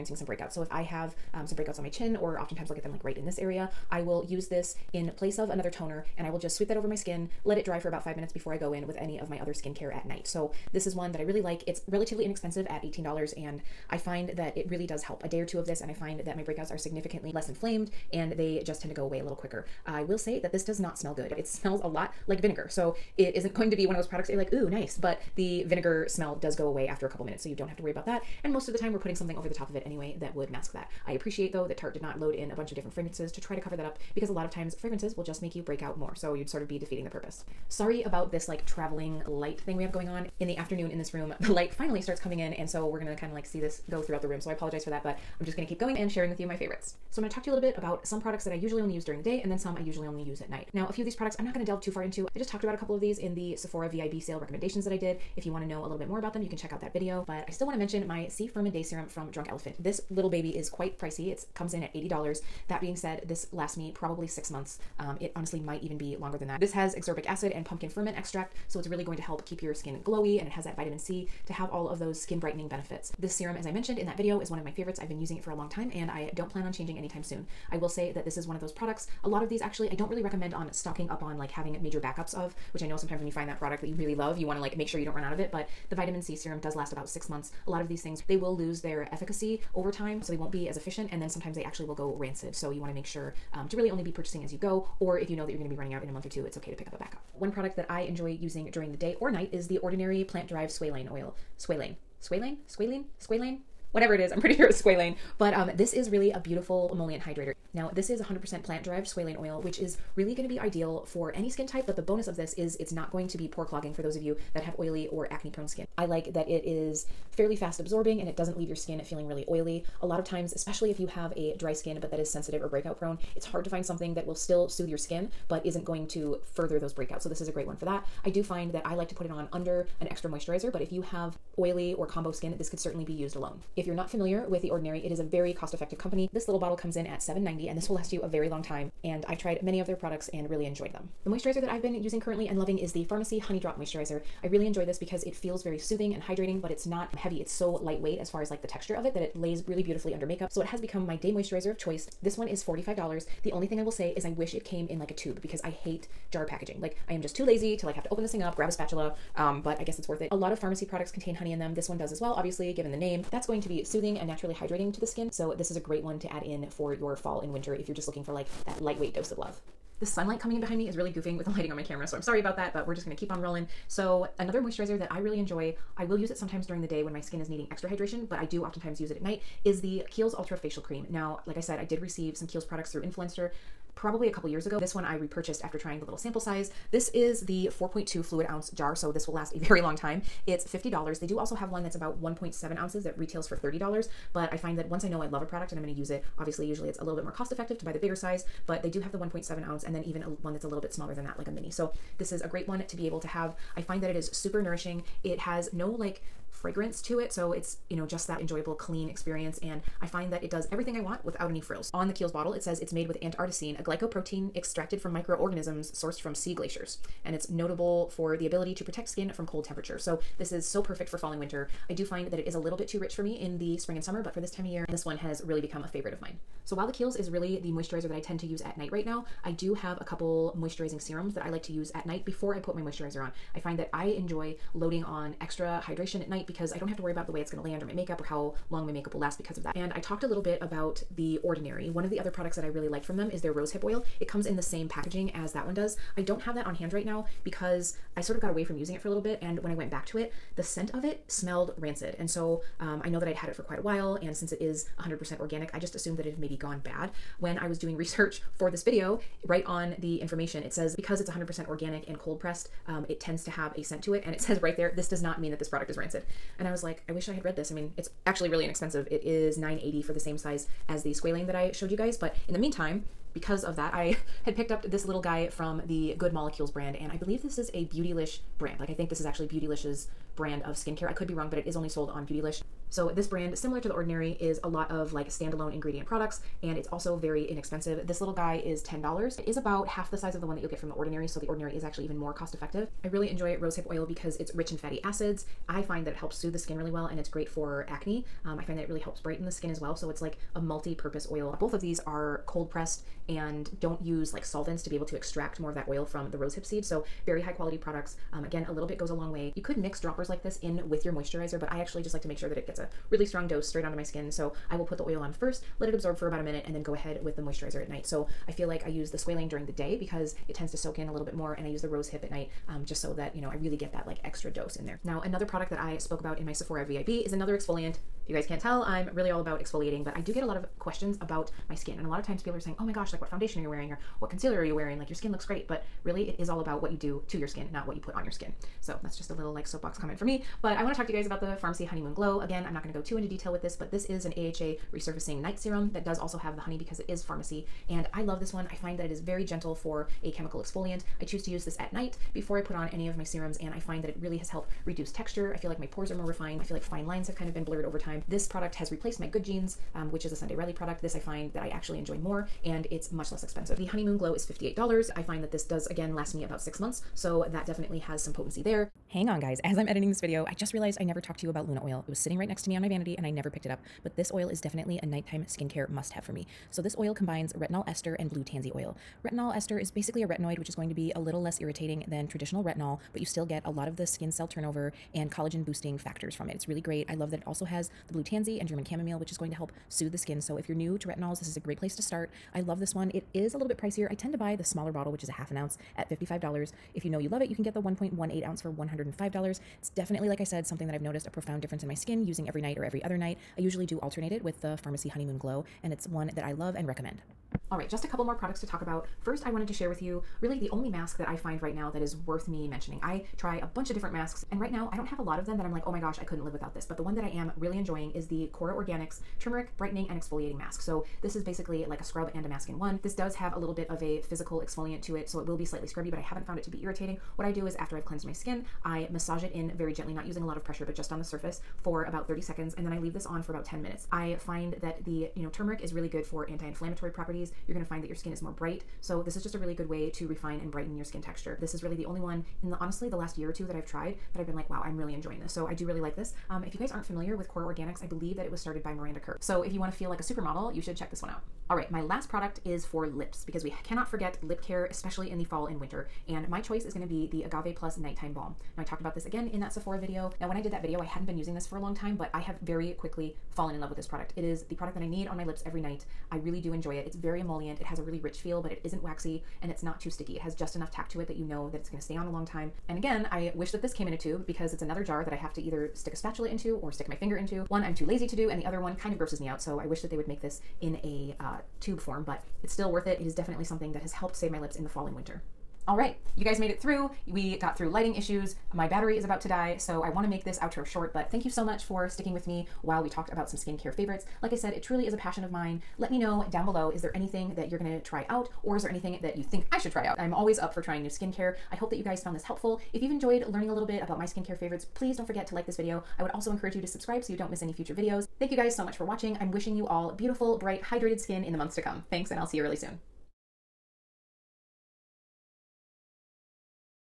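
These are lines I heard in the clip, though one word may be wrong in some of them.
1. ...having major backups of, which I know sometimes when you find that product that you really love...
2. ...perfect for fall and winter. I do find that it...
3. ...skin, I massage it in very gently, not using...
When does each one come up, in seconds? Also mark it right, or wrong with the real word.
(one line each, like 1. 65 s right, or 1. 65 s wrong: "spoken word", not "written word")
1. 81 s right
2. 220 s right
3. 428 s right.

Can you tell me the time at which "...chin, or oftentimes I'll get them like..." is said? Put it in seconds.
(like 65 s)
1 s.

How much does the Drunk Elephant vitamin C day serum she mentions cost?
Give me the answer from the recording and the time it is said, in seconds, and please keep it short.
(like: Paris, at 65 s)
$80, at 61 s.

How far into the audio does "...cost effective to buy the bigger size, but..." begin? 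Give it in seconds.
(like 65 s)
197 s.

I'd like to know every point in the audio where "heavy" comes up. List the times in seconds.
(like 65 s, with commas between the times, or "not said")
147 s.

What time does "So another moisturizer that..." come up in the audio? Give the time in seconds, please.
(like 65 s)
173 s.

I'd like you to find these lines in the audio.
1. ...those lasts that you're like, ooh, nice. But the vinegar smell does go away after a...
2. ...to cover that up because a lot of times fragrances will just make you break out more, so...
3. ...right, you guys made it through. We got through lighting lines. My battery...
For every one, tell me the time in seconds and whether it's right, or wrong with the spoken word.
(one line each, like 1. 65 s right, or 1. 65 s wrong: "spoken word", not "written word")
1. 23 s wrong: "products", not "lasts"
2. 33 s right
3. 485 s wrong: "issues", not "lines".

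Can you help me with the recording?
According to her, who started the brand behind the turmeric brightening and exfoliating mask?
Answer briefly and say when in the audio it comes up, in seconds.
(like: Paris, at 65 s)
Miranda Kerr, at 448 s.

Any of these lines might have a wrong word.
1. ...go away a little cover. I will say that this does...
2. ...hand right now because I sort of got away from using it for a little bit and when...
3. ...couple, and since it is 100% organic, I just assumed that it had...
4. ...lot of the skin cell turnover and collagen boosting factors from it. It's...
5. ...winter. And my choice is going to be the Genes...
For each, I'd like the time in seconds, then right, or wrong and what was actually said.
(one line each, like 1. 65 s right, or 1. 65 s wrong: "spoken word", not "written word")
1. 18 s wrong: "quicker", not "cover"
2. 246 s right
3. 253 s wrong: "while", not "couple"
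4. 383 s right
5. 455 s wrong: "Agave", not "Genes".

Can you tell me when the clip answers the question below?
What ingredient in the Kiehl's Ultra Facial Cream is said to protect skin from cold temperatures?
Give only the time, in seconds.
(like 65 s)
213 s.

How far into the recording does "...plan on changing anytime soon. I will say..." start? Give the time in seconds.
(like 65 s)
76 s.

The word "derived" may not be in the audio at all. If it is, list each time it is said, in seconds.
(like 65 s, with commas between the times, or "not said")
100 s, 108 s.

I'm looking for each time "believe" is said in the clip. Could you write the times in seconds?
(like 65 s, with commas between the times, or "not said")
277 s, 448 s.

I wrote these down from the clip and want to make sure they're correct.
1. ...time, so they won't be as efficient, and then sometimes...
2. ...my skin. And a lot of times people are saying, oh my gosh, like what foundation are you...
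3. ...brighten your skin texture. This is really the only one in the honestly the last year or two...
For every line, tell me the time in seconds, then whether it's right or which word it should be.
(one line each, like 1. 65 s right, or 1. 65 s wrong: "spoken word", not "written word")
1. 89 s right
2. 331 s right
3. 440 s right.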